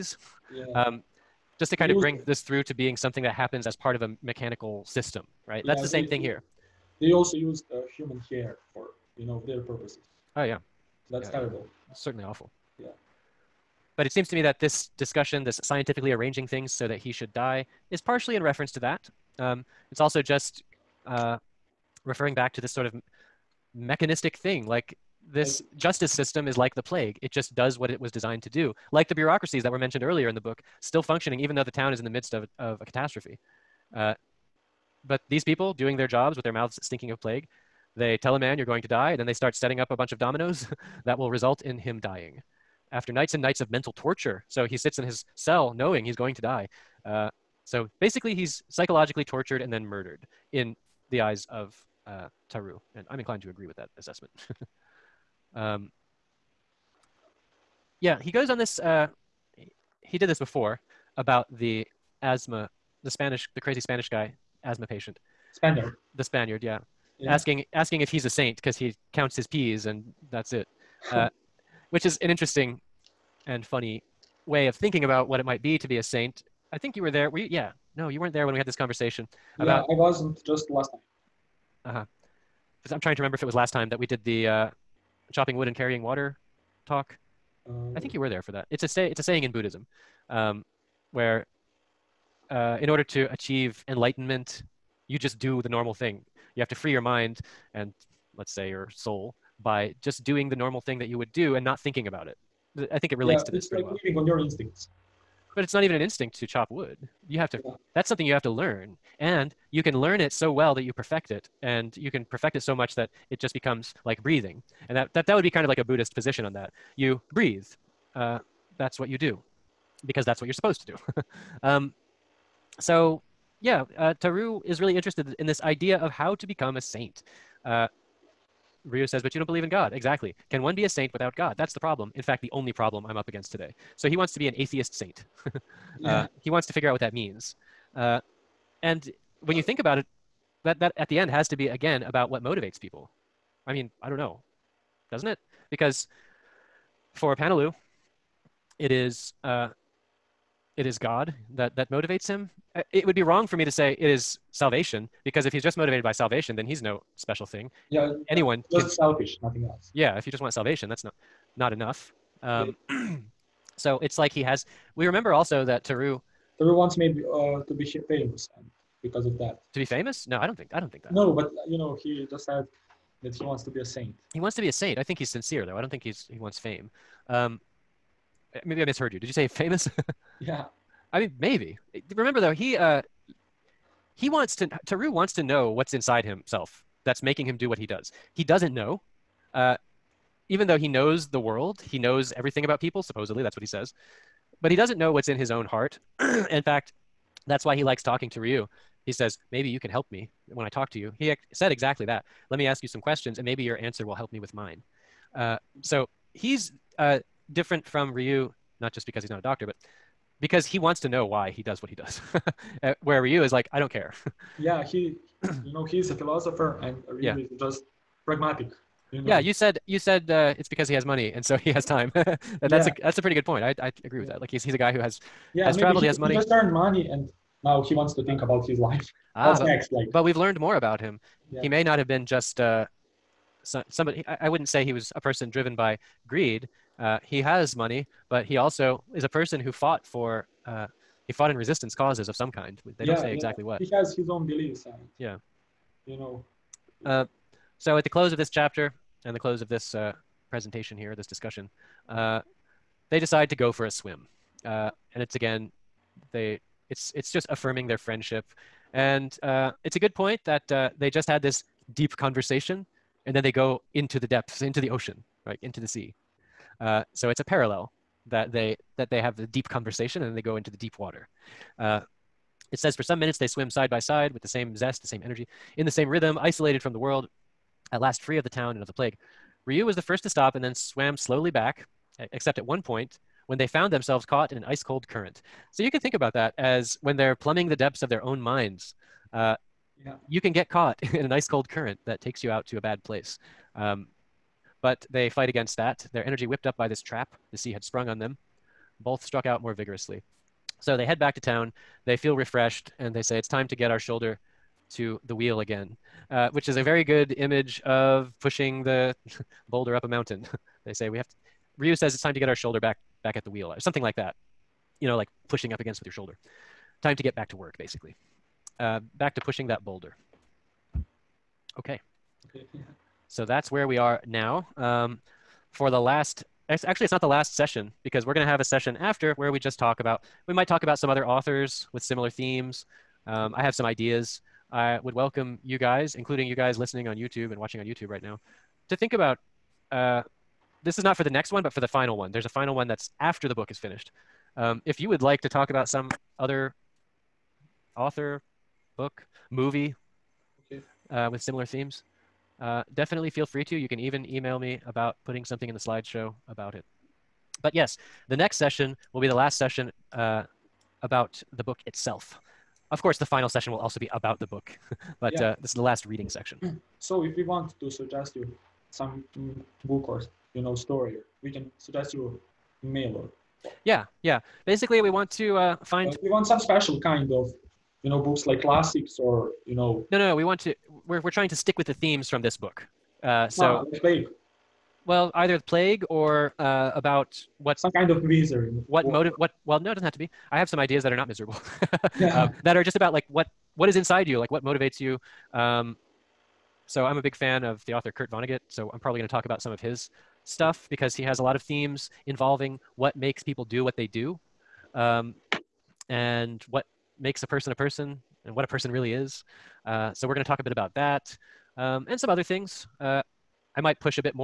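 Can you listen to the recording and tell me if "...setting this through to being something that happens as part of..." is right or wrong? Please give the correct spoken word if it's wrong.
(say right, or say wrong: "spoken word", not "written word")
wrong: "bring", not "setting".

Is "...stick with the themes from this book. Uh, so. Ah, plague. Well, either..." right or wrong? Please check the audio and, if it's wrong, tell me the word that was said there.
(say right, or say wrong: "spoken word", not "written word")
right.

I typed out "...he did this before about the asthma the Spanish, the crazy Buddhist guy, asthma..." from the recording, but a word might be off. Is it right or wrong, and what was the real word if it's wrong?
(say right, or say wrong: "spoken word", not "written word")
wrong: "Spanish", not "Buddhist".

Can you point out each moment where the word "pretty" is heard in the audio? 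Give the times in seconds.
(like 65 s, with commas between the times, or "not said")
103 s, 223 s.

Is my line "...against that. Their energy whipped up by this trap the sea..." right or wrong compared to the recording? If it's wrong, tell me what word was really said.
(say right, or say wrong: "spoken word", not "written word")
right.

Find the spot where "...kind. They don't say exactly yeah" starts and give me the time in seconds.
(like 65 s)
242 s.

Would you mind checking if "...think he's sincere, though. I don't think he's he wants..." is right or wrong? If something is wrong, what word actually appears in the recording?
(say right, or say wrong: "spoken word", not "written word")
right.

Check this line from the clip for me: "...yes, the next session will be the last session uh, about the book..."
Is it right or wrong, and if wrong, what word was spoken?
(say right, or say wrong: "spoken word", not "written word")
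right.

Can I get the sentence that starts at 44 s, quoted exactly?
So he sits in his cell knowing he's going to die.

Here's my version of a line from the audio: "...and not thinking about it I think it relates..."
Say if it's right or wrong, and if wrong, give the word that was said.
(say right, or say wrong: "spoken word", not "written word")
right.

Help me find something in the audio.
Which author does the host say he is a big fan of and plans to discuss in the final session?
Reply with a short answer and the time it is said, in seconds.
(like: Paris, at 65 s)
Kurt Vonnegut, at 398 s.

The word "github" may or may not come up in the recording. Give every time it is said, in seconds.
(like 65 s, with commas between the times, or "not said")
not said.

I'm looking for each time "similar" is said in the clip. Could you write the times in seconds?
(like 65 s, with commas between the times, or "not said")
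332 s, 351 s.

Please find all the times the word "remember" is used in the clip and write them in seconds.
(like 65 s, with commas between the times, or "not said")
83 s, 165 s, 182 s.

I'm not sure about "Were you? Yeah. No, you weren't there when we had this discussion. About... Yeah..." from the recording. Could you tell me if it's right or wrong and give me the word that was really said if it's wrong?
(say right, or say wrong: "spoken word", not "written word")
wrong: "conversation", not "discussion".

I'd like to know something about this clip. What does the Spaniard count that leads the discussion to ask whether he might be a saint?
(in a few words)
his peas.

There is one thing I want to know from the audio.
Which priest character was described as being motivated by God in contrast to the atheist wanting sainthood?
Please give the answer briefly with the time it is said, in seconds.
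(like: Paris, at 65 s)
Panalu, at 147 s.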